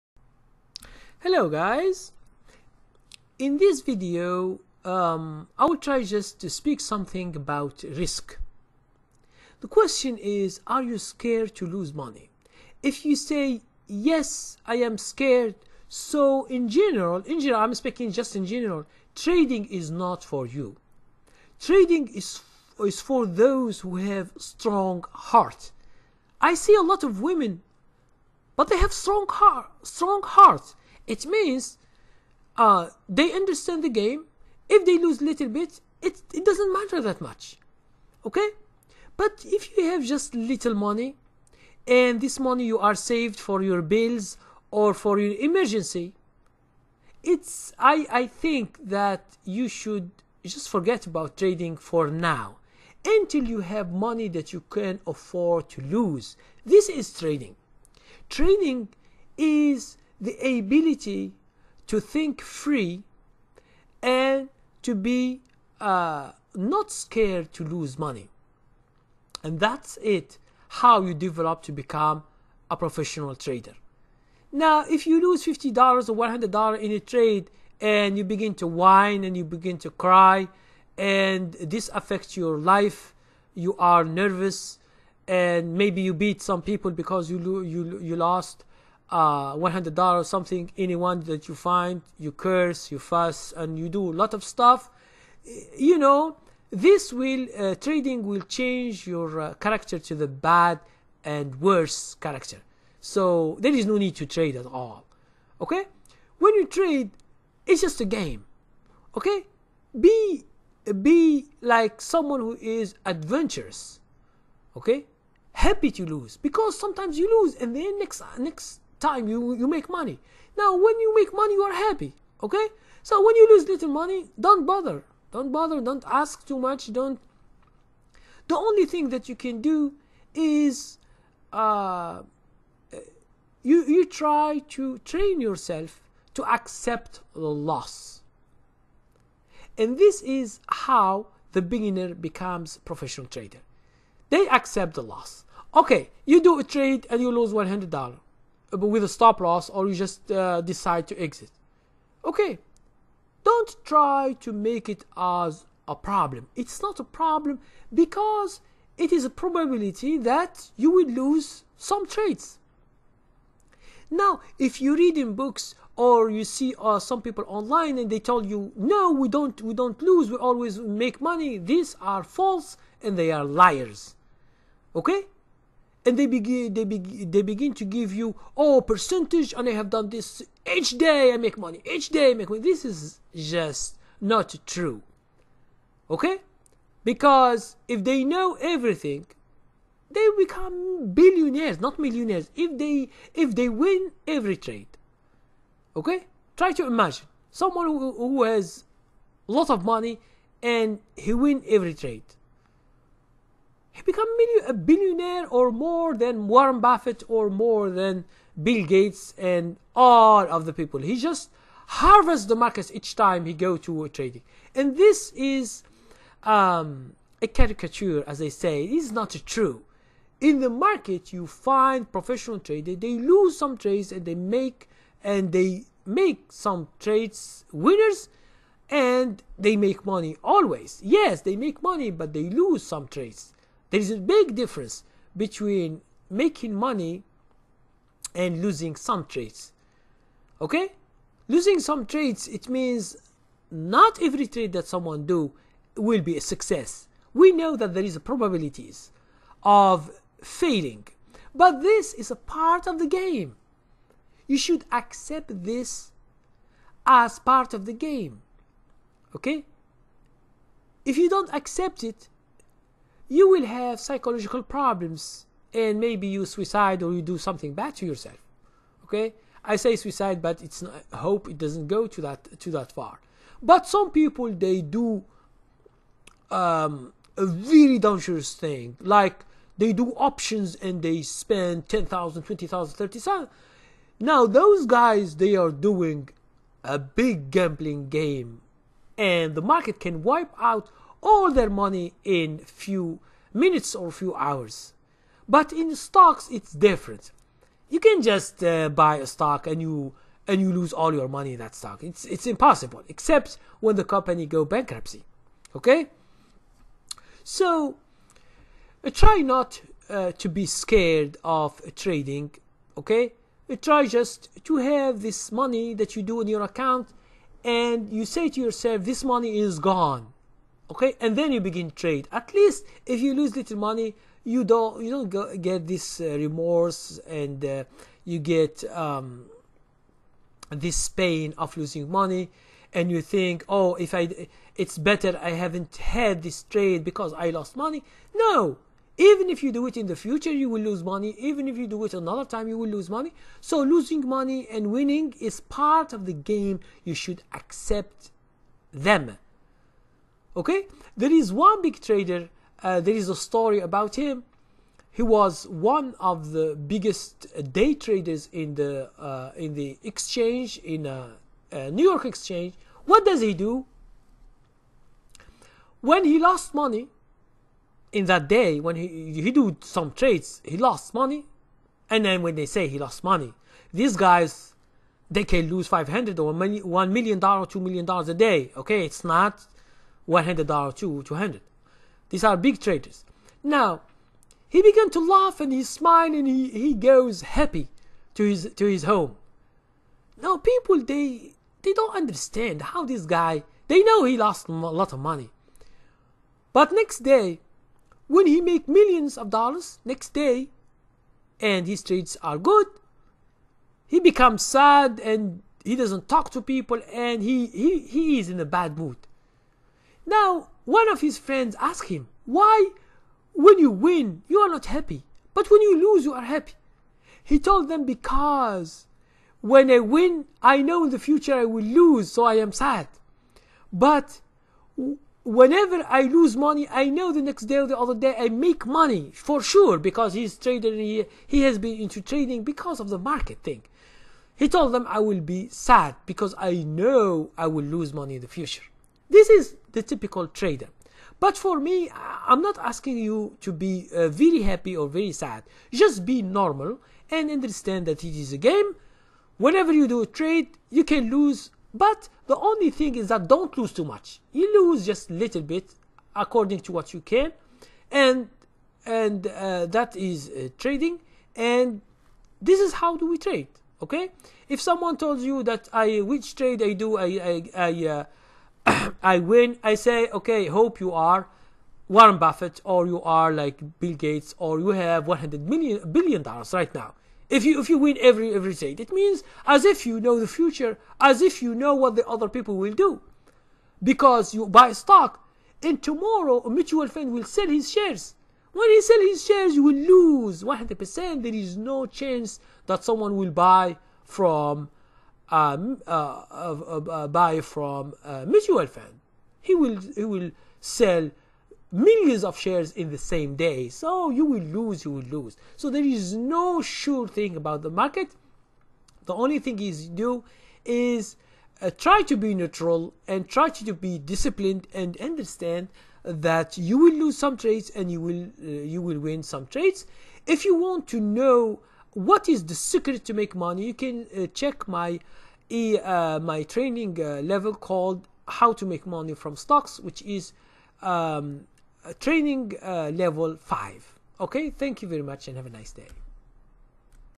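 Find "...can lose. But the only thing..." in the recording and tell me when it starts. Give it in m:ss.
7:31.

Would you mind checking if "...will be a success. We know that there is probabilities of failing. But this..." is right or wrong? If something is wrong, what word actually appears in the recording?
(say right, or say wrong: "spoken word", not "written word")
right.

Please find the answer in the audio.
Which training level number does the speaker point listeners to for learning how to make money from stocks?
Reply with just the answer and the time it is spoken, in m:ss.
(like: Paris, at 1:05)
5, at 8:53.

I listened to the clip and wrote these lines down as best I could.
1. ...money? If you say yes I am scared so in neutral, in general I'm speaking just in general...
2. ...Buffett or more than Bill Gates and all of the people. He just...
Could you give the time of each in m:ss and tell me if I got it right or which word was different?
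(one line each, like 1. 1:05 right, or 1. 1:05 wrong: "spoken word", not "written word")
1. 0:11 wrong: "general", not "neutral"
2. 3:26 right.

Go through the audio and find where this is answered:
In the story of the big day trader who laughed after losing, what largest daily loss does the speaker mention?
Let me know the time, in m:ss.
6:17.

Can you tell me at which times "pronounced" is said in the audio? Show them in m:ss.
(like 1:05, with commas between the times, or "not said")
not said.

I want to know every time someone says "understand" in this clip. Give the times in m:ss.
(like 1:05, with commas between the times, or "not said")
0:33, 6:32, 7:27, 8:35.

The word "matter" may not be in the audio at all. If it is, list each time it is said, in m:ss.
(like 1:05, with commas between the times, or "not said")
0:36.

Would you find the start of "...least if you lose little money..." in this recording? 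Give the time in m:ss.
5:22.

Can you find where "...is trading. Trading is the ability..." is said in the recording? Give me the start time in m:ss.
0:56.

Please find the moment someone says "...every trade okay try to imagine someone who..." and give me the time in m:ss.
3:14.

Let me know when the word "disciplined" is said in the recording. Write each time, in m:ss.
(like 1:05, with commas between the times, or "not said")
8:34.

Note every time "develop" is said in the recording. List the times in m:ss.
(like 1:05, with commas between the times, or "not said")
1:11.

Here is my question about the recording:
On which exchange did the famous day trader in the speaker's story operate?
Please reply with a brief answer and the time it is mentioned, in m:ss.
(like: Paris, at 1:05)
New York Exchange, at 6:01.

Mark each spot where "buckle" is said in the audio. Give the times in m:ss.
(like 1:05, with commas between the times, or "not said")
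not said.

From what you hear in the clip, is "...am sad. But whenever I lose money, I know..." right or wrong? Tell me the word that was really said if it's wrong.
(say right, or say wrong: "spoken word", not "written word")
right.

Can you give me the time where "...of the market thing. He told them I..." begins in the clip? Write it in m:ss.
7:13.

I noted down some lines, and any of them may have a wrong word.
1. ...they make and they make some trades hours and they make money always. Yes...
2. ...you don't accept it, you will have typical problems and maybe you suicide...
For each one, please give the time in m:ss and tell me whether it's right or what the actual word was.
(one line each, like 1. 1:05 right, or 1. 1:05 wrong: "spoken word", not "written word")
1. 3:44 wrong: "winners", not "hours"
2. 4:21 wrong: "psychological", not "typical".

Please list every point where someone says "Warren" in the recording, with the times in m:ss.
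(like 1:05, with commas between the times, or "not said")
3:26, 7:52.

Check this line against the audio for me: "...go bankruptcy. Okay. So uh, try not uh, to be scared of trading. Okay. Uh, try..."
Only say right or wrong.
right.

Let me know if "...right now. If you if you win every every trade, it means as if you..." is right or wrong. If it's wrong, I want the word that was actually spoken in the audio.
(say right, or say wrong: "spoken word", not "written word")
right.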